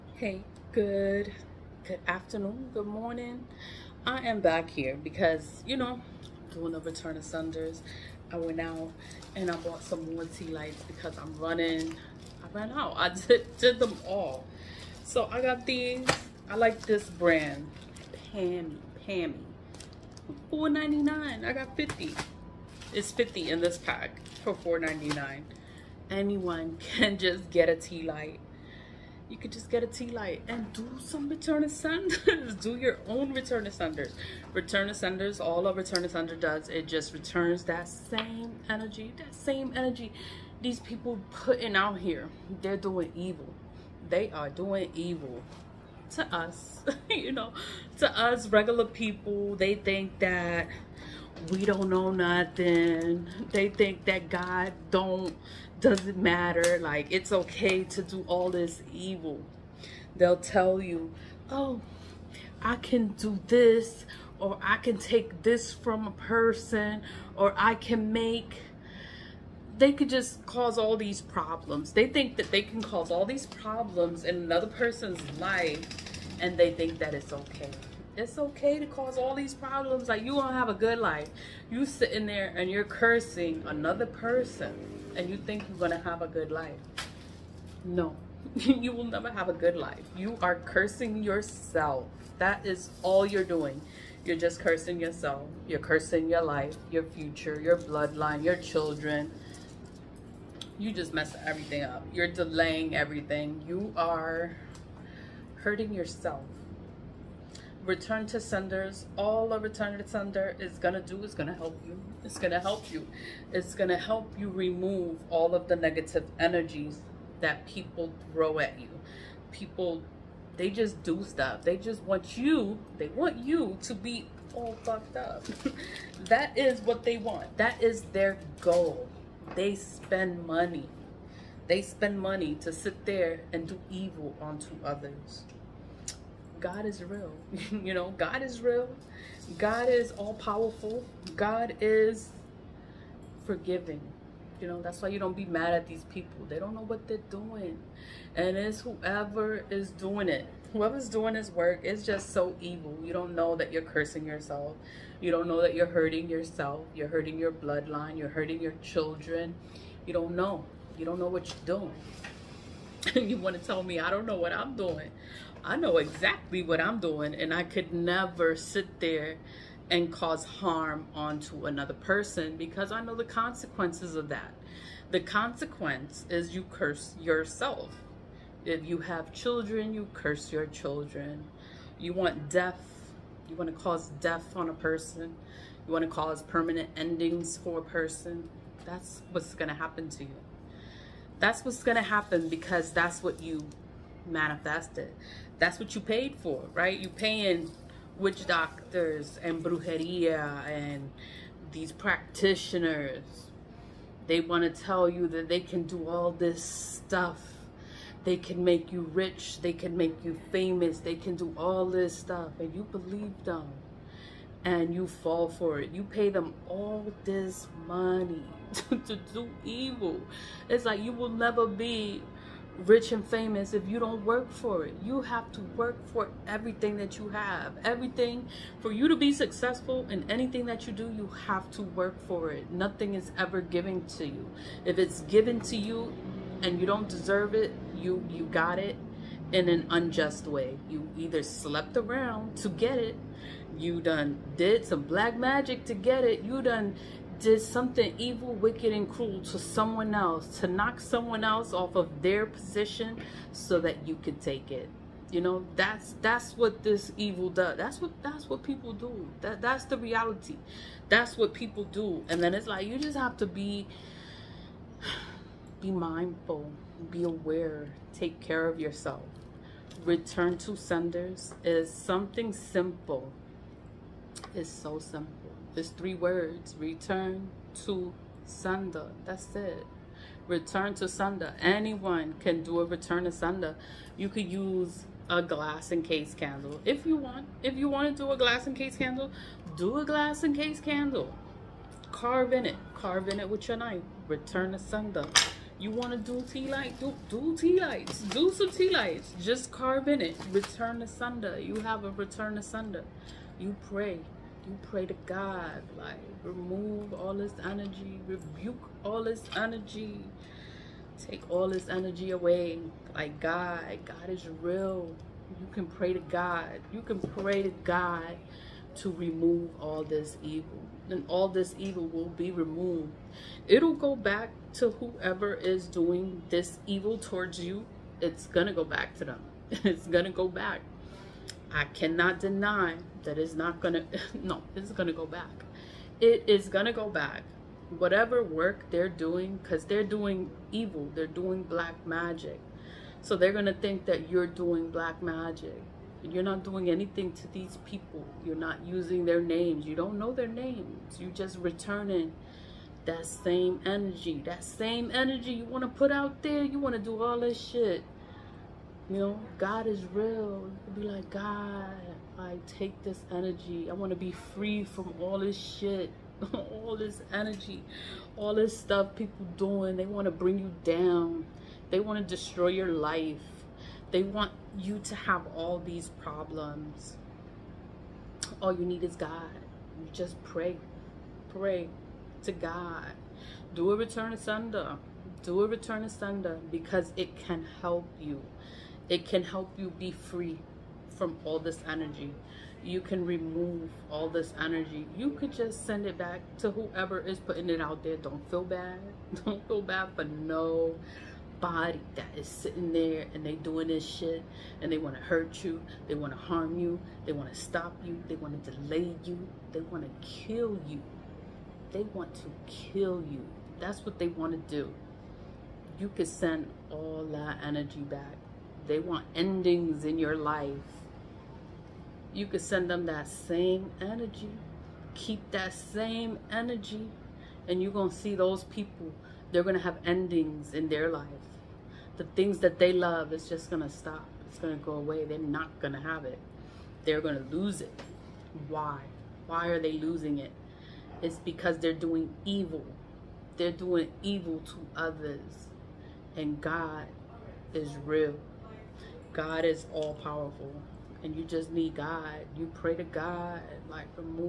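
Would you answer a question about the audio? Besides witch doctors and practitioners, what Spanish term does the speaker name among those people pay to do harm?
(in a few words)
brujeria.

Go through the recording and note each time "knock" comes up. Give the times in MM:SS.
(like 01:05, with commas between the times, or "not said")
04:10.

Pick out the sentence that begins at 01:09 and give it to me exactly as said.
They could just cause all these problems.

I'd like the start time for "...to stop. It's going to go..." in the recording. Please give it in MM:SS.
07:13.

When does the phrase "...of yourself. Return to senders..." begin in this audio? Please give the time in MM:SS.
04:28.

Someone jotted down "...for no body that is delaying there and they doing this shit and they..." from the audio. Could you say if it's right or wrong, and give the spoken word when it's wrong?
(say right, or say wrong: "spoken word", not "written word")
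wrong: "sitting", not "delaying".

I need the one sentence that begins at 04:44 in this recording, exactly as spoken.
You could use a glass and case candle if you want.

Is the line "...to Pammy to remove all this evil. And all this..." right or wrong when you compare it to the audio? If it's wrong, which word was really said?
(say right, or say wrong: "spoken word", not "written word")
wrong: "God", not "Pammy".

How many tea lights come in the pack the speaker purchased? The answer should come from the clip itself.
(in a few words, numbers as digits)
50.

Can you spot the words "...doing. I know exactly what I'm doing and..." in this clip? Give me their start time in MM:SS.
02:44.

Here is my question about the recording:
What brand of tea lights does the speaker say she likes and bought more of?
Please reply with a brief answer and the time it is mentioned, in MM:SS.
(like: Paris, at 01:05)
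Pammy, at 00:19.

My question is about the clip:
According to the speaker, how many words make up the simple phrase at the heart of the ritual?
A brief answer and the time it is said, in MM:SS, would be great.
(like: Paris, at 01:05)
3, at 04:35.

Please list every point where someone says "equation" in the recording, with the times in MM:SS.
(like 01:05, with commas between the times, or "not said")
not said.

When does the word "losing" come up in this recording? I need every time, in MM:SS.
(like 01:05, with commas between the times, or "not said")
07:19.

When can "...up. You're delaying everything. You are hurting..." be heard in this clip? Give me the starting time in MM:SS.
01:41.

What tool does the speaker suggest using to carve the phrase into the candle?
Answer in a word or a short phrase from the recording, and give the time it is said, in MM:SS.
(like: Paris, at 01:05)
Knife, at 04:53.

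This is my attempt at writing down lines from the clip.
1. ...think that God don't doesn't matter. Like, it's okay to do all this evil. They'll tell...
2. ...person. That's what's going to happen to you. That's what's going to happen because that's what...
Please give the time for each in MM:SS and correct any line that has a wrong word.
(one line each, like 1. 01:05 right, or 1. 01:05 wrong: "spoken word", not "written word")
1. 00:53 right
2. 03:07 right.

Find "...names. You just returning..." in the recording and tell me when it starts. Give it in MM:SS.
05:50.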